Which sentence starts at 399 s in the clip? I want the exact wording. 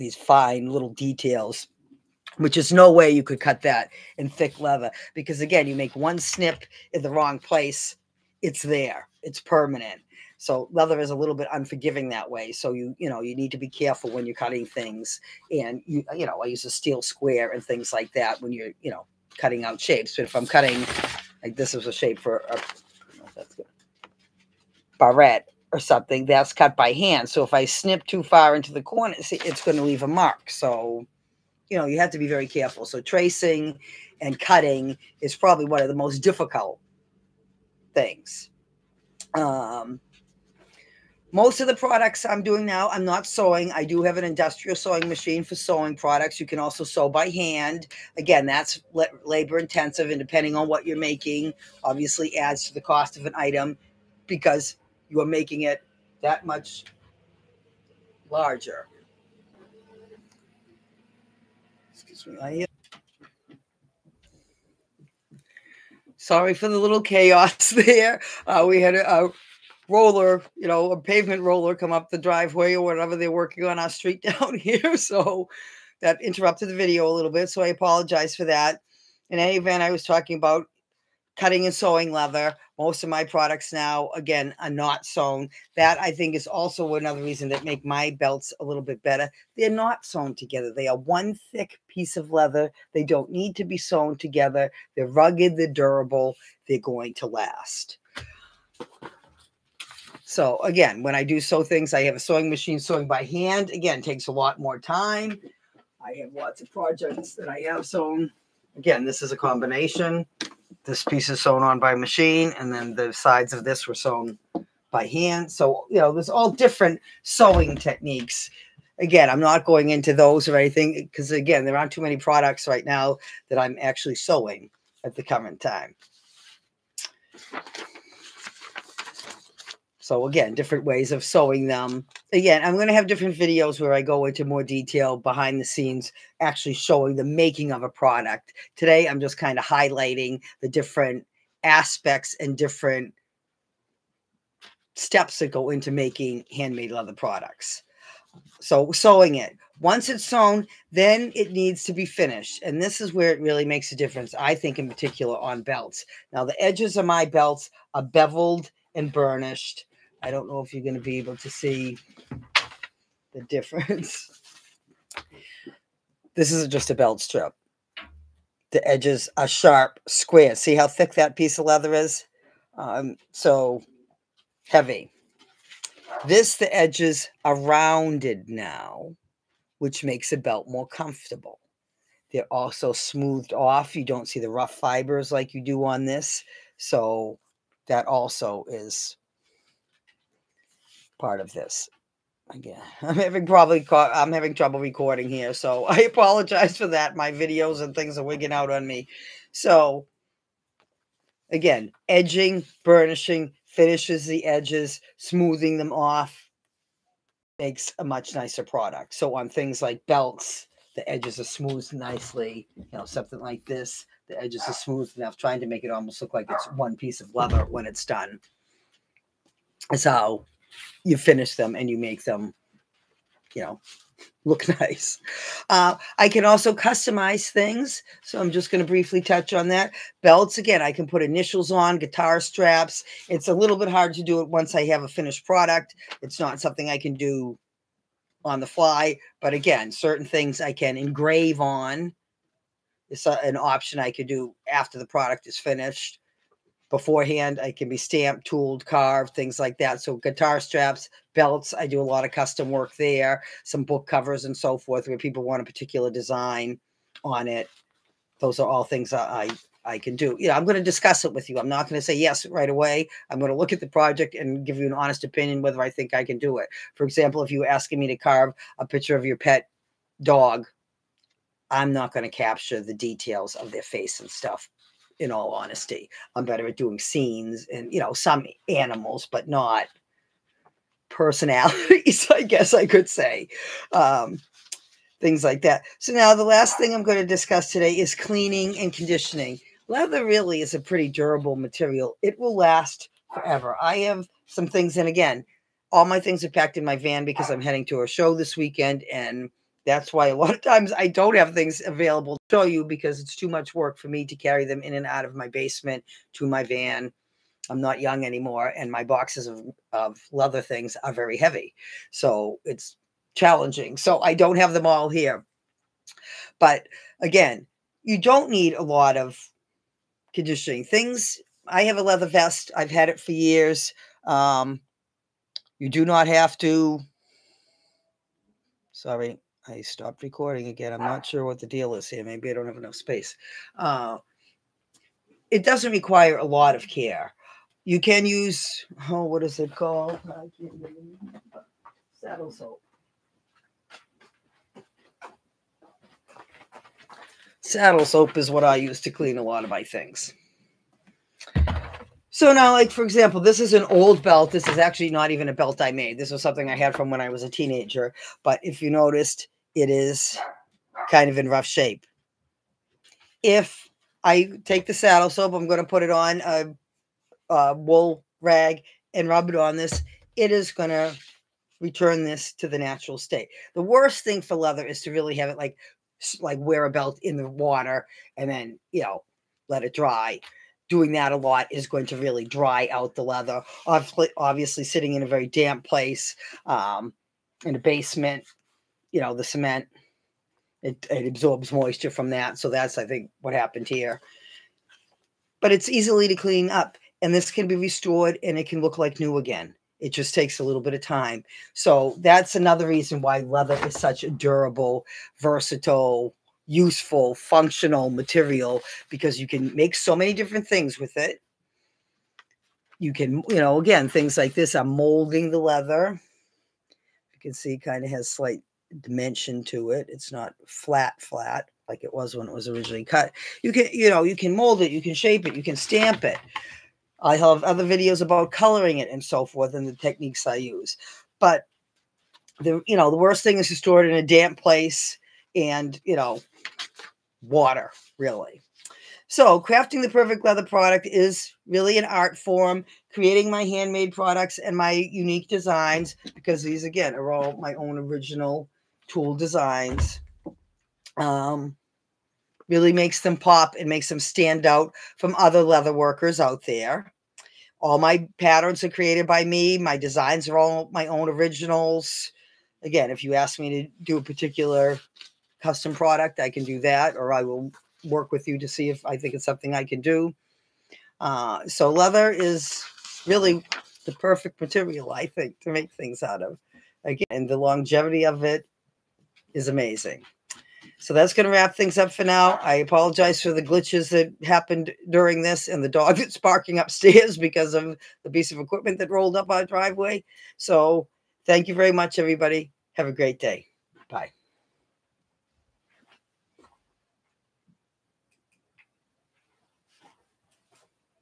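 It just takes a little bit of time.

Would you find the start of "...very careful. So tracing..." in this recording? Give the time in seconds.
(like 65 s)
32 s.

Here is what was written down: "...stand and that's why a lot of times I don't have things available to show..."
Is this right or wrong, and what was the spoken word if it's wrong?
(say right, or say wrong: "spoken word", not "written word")
wrong: "weekend", not "stand".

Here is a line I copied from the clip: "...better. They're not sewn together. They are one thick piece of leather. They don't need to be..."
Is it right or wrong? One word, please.
right.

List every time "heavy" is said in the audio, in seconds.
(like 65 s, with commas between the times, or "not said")
174 s, 311 s.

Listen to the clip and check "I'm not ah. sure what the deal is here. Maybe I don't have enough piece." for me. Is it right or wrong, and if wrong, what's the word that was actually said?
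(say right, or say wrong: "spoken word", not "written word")
wrong: "space", not "piece".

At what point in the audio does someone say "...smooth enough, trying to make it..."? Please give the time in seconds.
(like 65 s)
214 s.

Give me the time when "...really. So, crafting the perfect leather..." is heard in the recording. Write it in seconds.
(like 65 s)
438 s.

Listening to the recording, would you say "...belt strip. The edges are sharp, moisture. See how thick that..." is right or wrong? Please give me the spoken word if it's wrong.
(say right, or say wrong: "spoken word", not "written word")
wrong: "square", not "moisture".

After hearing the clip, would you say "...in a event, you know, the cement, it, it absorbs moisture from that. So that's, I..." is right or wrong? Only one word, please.
wrong.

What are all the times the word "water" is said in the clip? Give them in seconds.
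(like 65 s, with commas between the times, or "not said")
377 s, 437 s.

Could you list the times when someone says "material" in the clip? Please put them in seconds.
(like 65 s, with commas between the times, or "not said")
291 s, 408 s, 474 s.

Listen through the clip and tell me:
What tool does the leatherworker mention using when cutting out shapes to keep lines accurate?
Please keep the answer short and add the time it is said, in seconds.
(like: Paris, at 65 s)
steel square, at 16 s.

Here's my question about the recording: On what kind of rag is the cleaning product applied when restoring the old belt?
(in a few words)
wool rag.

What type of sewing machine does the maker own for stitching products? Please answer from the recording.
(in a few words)
industrial sewing machine.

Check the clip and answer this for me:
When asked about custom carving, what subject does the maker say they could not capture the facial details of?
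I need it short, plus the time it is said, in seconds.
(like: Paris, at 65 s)
pet dog, at 269 s.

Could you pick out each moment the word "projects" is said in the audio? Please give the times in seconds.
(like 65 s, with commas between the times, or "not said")
106 s, 263 s.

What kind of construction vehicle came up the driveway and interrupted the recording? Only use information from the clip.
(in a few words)
pavement roller.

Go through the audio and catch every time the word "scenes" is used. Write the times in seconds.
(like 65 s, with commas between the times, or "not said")
135 s, 276 s.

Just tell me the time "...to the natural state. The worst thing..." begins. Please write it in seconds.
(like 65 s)
372 s.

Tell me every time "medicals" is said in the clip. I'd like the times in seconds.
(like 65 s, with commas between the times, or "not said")
not said.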